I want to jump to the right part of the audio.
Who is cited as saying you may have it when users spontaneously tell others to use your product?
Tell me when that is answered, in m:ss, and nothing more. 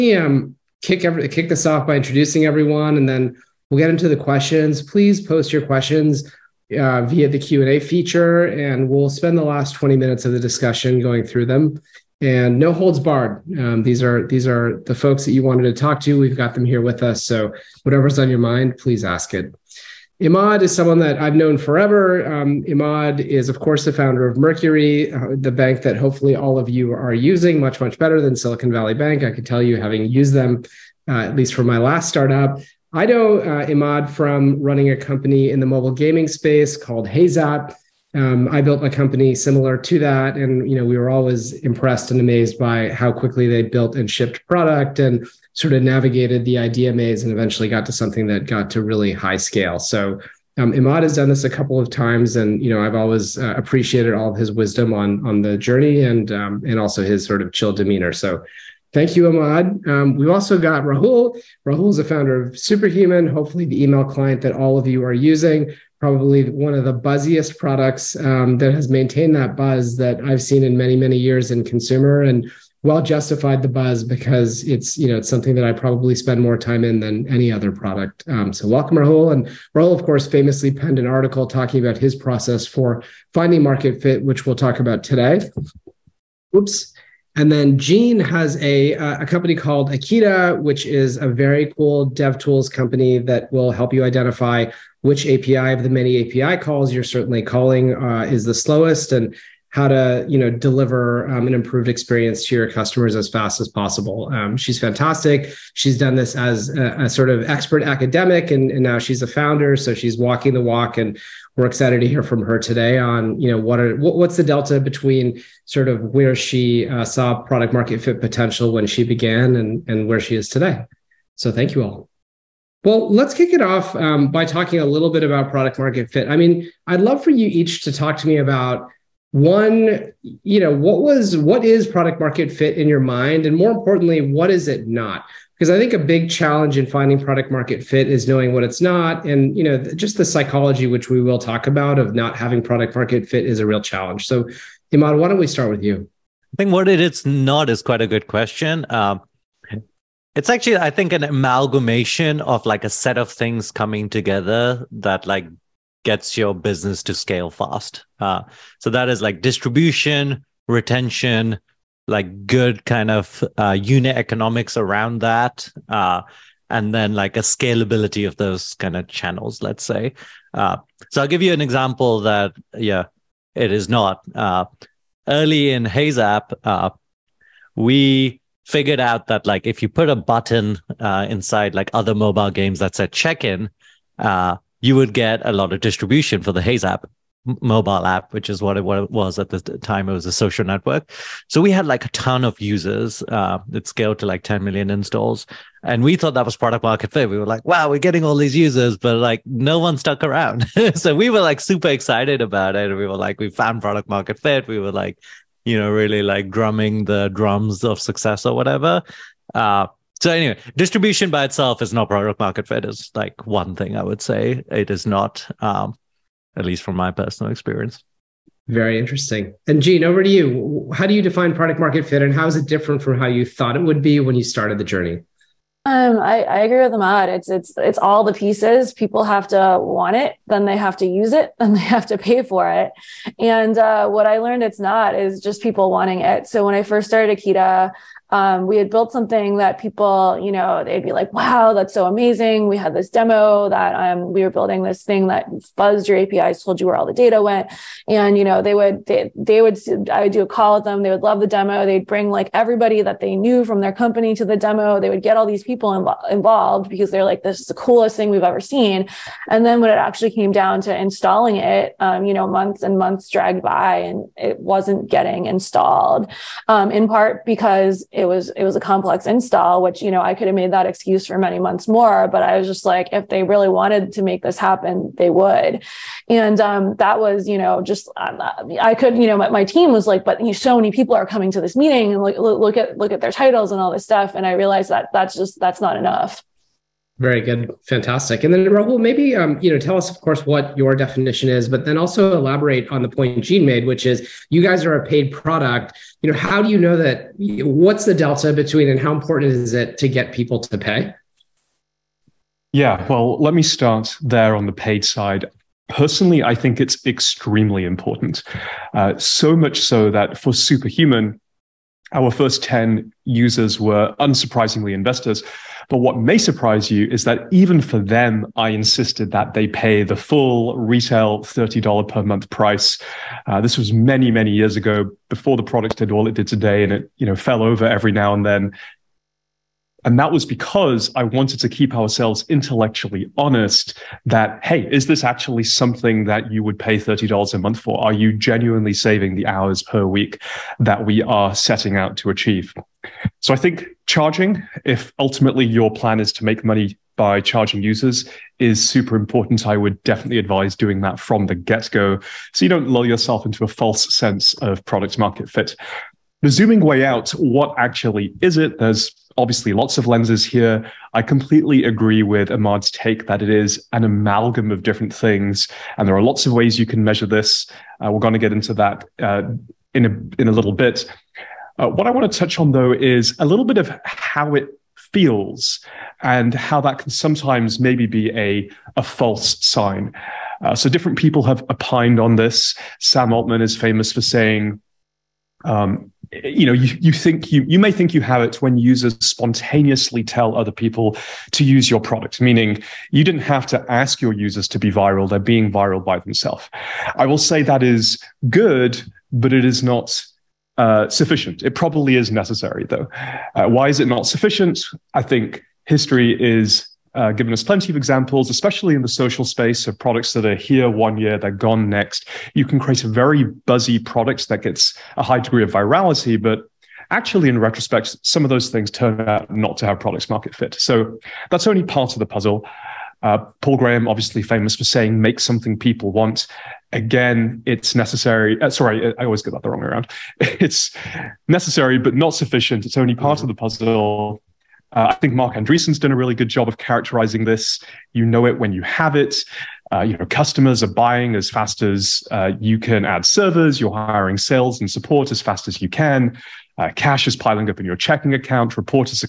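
6:22.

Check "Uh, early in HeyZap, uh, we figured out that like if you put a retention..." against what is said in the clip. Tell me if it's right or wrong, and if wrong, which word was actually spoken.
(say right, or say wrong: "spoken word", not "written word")
wrong: "button", not "retention".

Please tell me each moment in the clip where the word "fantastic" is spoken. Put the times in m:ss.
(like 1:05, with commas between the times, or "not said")
1:44, 4:47.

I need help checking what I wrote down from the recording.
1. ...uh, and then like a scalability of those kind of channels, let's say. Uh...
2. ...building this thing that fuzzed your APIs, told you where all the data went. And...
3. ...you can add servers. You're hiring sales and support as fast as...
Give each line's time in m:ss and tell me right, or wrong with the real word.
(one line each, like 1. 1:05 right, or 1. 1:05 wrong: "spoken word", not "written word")
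1. 2:45 right
2. 4:04 right
3. 7:22 right.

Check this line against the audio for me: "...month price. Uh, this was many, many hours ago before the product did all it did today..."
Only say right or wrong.
wrong.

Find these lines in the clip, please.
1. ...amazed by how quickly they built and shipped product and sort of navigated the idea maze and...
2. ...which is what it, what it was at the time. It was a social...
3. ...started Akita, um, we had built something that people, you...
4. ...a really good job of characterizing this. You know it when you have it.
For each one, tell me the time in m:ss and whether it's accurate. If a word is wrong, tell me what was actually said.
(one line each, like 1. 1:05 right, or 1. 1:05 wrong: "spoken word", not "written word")
1. 0:42 right
2. 3:08 right
3. 3:57 right
4. 7:16 right.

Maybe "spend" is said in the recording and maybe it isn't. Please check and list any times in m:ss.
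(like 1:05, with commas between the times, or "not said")
0:09, 1:16.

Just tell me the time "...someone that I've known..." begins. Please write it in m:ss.
0:20.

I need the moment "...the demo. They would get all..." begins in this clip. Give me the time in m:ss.
4:14.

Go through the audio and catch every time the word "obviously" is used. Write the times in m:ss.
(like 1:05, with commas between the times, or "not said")
5:59, 7:04.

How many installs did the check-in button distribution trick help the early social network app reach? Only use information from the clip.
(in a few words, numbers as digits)
10 million.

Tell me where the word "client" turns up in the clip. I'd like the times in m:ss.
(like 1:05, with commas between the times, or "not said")
1:04.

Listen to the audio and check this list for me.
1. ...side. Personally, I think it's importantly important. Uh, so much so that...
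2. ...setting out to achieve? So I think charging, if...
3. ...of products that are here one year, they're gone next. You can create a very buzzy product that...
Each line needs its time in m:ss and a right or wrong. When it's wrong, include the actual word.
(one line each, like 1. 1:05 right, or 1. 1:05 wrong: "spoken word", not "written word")
1. 5:05 wrong: "extremely", not "importantly"
2. 5:41 right
3. 6:49 right.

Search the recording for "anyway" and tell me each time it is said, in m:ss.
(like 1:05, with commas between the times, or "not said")
3:30.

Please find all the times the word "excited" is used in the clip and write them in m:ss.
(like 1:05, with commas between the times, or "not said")
1:51, 3:21.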